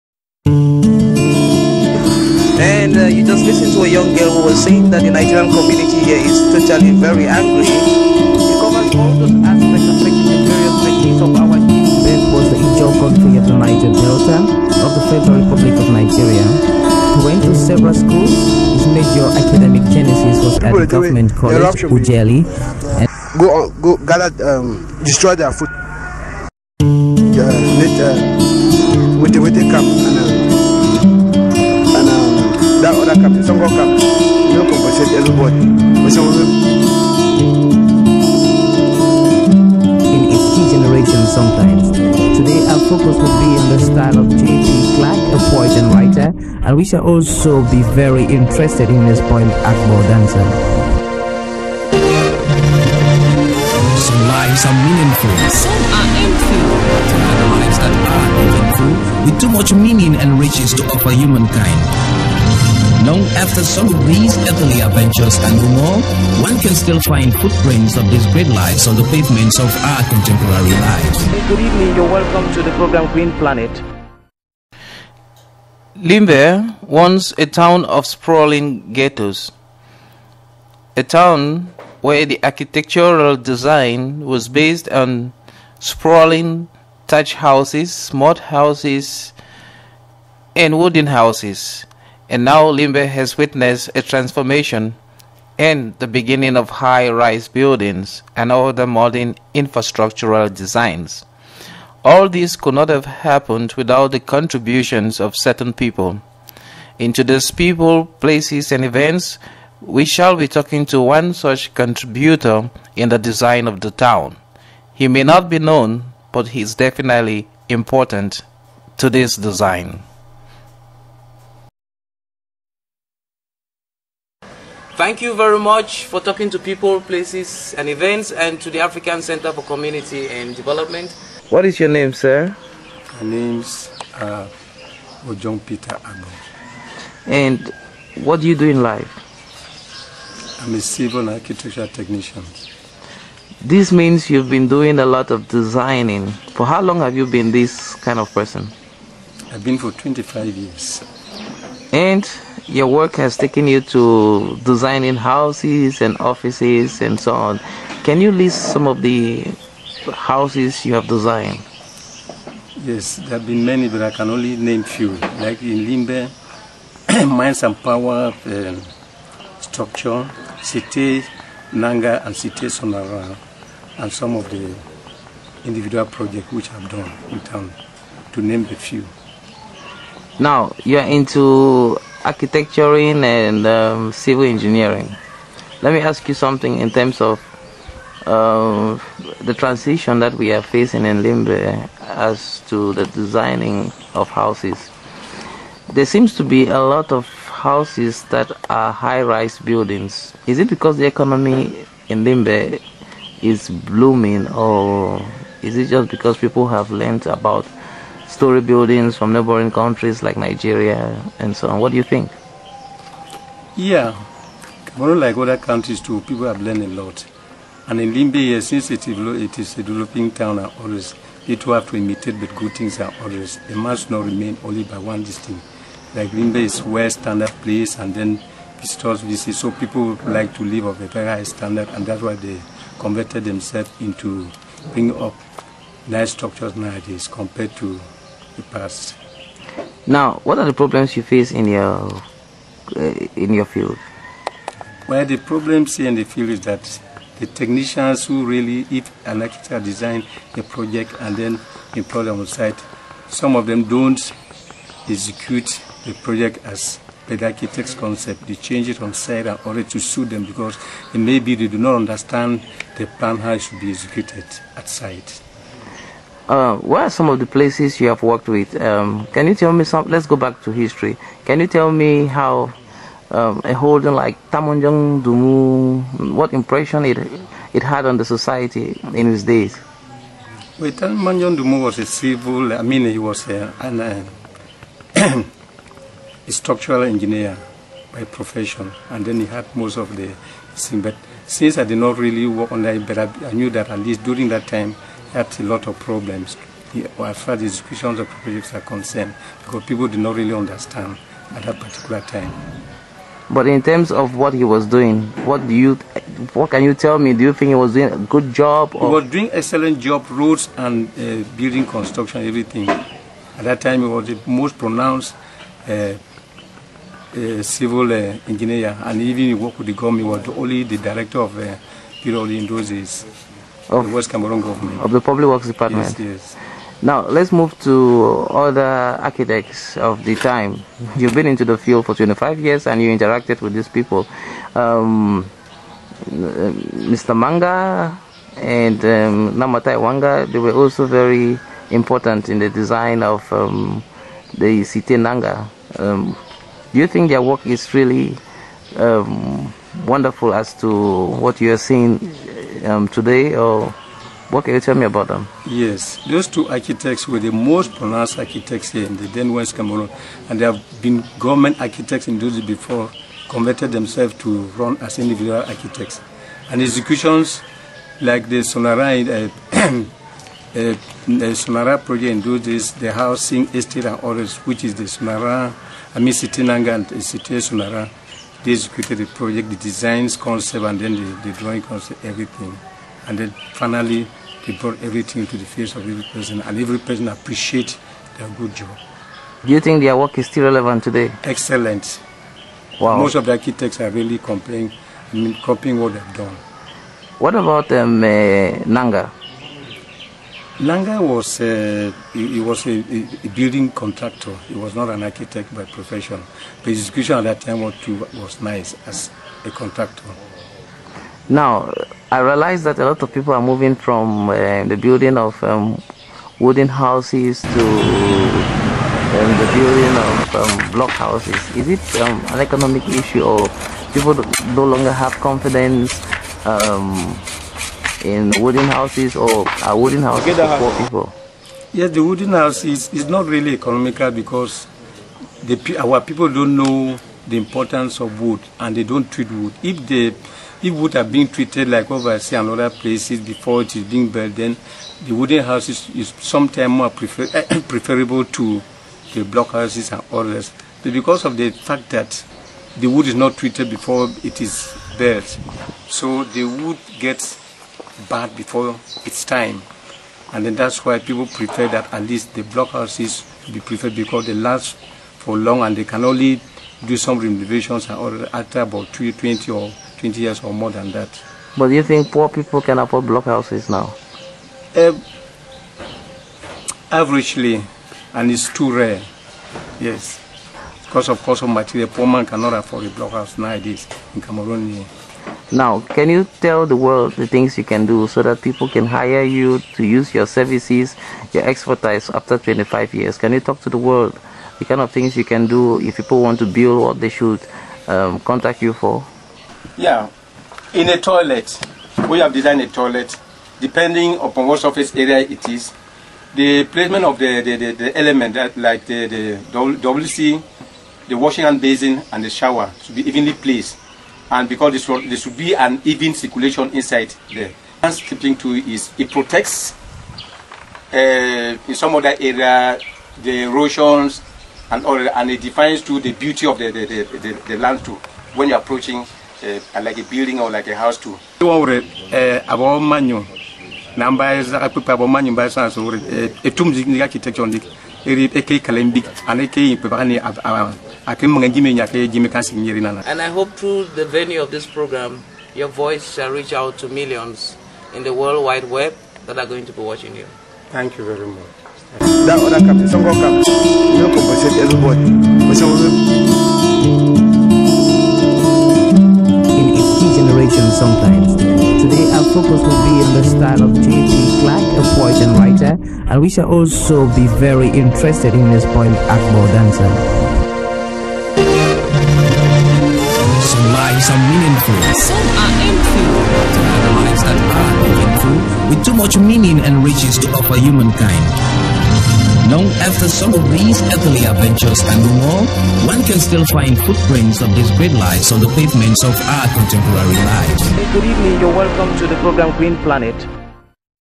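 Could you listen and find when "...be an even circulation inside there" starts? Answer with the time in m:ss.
8:35.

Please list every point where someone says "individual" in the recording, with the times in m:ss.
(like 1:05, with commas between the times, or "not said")
2:55, 6:05.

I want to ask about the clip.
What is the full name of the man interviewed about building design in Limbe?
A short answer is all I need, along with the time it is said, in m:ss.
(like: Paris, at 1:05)
Ojong Peter Agbor, at 2:15.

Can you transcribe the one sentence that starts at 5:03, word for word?
But in terms of what he was doing, what do you, what can you tell me?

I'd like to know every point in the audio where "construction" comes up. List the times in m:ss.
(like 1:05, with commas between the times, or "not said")
5:11.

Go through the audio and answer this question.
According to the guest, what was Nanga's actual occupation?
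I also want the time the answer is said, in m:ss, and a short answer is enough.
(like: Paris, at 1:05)
Building contractor, at 6:43.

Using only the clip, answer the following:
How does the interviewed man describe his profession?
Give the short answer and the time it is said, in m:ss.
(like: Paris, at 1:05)
Civil architecture technician, at 2:20.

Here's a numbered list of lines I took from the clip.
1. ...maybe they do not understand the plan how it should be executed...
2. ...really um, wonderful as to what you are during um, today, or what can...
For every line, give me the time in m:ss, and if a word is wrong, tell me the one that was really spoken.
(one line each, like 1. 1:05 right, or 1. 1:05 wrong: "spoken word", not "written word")
1. 4:21 right
2. 5:47 wrong: "seeing", not "during".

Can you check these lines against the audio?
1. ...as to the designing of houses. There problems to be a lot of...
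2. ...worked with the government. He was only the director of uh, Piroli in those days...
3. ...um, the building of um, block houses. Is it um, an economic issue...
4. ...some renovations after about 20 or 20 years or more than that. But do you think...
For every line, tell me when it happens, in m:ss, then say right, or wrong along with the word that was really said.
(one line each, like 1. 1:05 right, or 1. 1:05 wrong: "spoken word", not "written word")
1. 3:12 wrong: "seems", not "problems"
2. 5:19 right
3. 6:57 right
4. 7:47 right.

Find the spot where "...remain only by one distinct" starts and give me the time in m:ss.
3:44.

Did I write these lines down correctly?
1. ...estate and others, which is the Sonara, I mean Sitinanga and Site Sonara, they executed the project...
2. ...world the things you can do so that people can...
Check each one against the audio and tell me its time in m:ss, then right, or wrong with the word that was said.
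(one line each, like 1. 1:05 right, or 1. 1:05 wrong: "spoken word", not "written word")
1. 6:13 right
2. 8:06 right.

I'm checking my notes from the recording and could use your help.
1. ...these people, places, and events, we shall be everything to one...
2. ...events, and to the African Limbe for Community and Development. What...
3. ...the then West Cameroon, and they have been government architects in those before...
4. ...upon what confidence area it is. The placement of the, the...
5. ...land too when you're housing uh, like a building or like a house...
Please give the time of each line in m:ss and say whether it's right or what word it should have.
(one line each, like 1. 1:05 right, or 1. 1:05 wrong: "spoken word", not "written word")
1. 1:47 wrong: "talking", not "everything"
2. 2:07 wrong: "Center", not "Limbe"
3. 5:59 right
4. 8:24 wrong: "surface", not "confidence"
5. 8:47 wrong: "approaching", not "housing".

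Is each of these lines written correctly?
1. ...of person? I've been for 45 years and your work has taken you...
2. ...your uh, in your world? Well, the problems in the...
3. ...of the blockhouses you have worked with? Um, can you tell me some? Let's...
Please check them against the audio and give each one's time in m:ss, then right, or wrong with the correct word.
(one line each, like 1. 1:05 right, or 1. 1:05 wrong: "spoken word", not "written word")
1. 2:28 wrong: "25", not "45"
2. 4:01 wrong: "field", not "world"
3. 4:27 wrong: "places", not "blockhouses".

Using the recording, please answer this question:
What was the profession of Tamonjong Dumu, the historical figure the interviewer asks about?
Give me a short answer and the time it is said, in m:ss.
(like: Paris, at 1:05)
Structural engineer, at 4:46.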